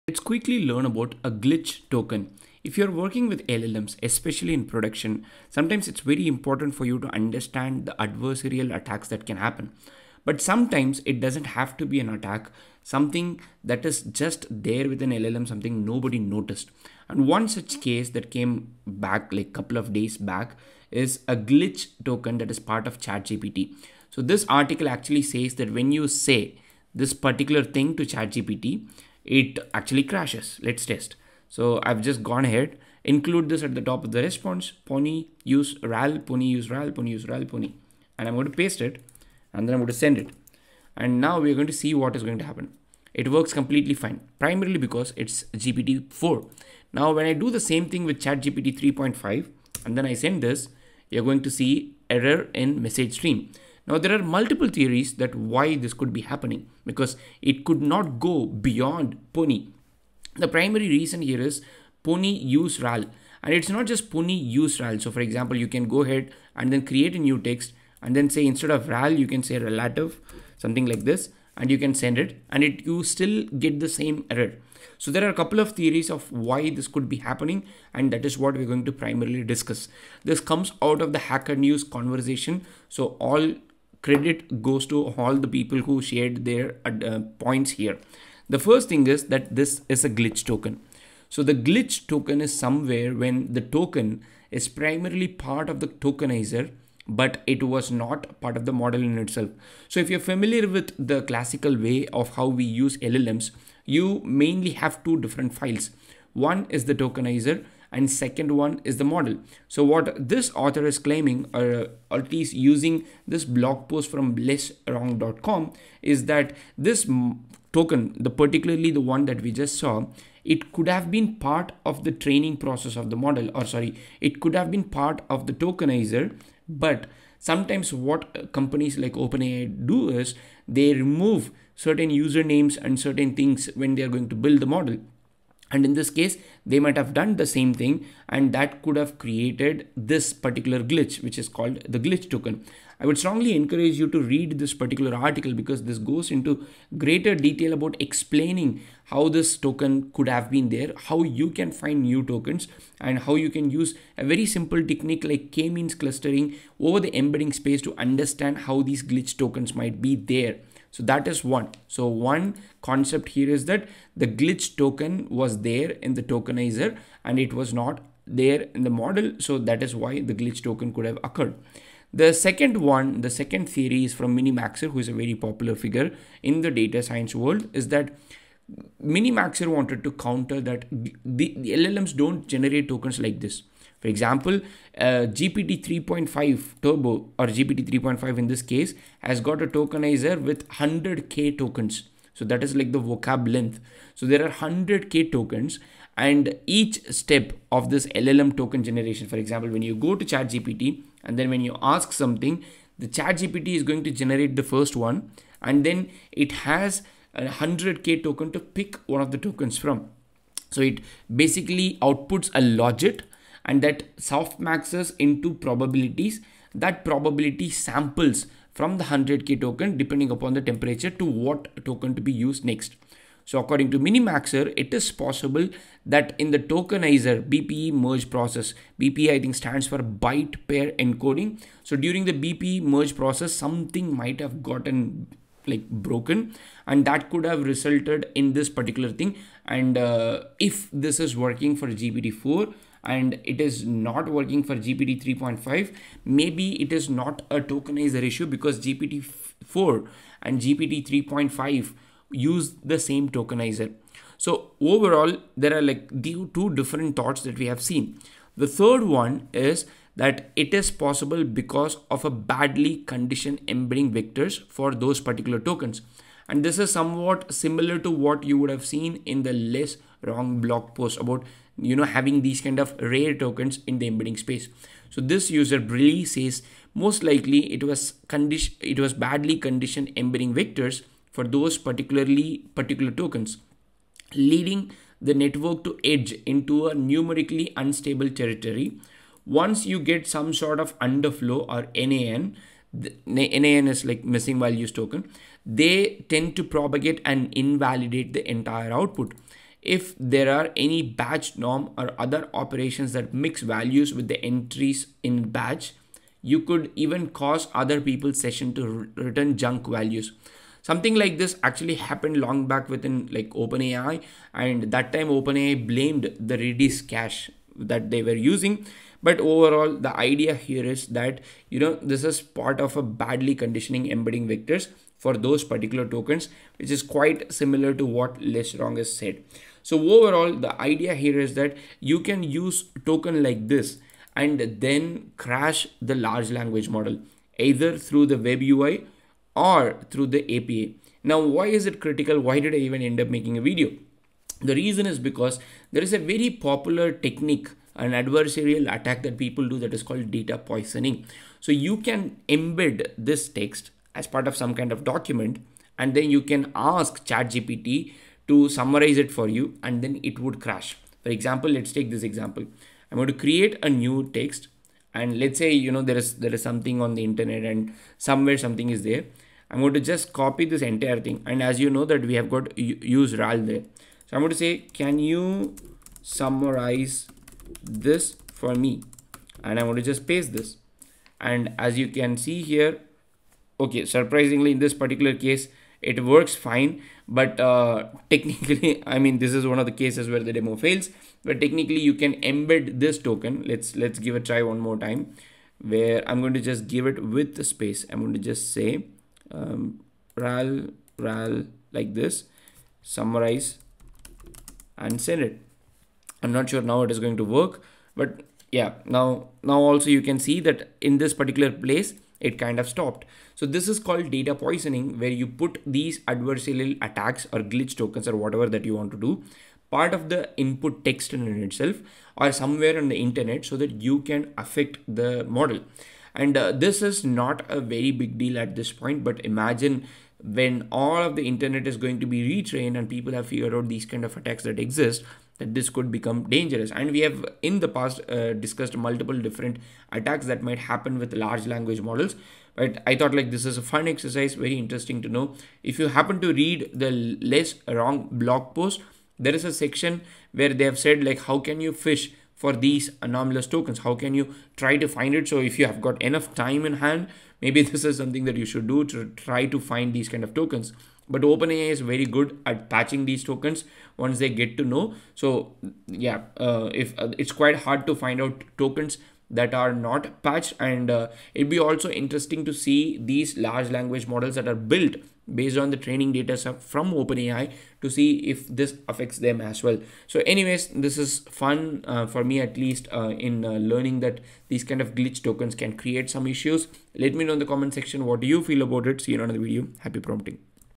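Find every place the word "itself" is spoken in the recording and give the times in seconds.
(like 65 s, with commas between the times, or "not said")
99 s, 421 s.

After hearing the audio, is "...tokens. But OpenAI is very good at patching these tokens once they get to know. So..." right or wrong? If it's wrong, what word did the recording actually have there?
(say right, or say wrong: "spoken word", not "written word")
right.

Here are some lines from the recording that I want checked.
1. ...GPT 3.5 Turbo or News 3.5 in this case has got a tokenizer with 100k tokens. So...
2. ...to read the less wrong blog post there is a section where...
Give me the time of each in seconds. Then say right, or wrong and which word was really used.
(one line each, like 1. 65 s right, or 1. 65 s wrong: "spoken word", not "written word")
1. 185 s wrong: "GPT", not "News"
2. 446 s right.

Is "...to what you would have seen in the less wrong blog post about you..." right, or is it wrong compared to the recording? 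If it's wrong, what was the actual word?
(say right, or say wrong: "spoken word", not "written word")
right.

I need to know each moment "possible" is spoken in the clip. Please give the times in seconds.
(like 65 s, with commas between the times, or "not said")
225 s, 260 s.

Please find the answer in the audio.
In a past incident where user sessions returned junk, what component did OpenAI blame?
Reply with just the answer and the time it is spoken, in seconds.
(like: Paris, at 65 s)
redis cache, at 316 s.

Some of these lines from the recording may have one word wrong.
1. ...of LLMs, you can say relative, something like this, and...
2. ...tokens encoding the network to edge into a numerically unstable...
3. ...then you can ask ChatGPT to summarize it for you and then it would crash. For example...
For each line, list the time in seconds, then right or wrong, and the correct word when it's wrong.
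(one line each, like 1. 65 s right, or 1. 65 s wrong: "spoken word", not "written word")
1. 68 s wrong: "RAL", not "LLMs"
2. 283 s wrong: "leading", not "encoding"
3. 356 s right.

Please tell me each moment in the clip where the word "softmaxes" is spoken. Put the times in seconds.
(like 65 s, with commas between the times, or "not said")
214 s.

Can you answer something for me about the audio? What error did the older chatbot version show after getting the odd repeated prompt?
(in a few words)
error in message stream.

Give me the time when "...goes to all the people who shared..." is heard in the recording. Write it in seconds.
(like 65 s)
84 s.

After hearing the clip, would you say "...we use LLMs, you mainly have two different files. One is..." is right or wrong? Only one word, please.
right.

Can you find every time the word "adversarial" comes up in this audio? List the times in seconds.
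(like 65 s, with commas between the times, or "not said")
7 s, 348 s, 416 s.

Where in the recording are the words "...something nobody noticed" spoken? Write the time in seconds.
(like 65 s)
15 s.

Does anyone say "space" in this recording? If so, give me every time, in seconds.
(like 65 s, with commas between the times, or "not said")
157 s, 274 s, 397 s.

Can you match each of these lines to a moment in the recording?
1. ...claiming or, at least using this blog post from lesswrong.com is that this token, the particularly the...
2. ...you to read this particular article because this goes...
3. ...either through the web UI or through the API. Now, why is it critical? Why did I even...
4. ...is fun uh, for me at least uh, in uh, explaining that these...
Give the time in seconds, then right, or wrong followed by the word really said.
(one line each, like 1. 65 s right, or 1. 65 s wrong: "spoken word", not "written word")
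1. 110 s right
2. 144 s right
3. 337 s right
4. 481 s wrong: "learning", not "explaining".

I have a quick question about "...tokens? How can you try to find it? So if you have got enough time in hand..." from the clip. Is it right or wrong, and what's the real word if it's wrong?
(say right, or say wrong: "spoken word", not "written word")
right.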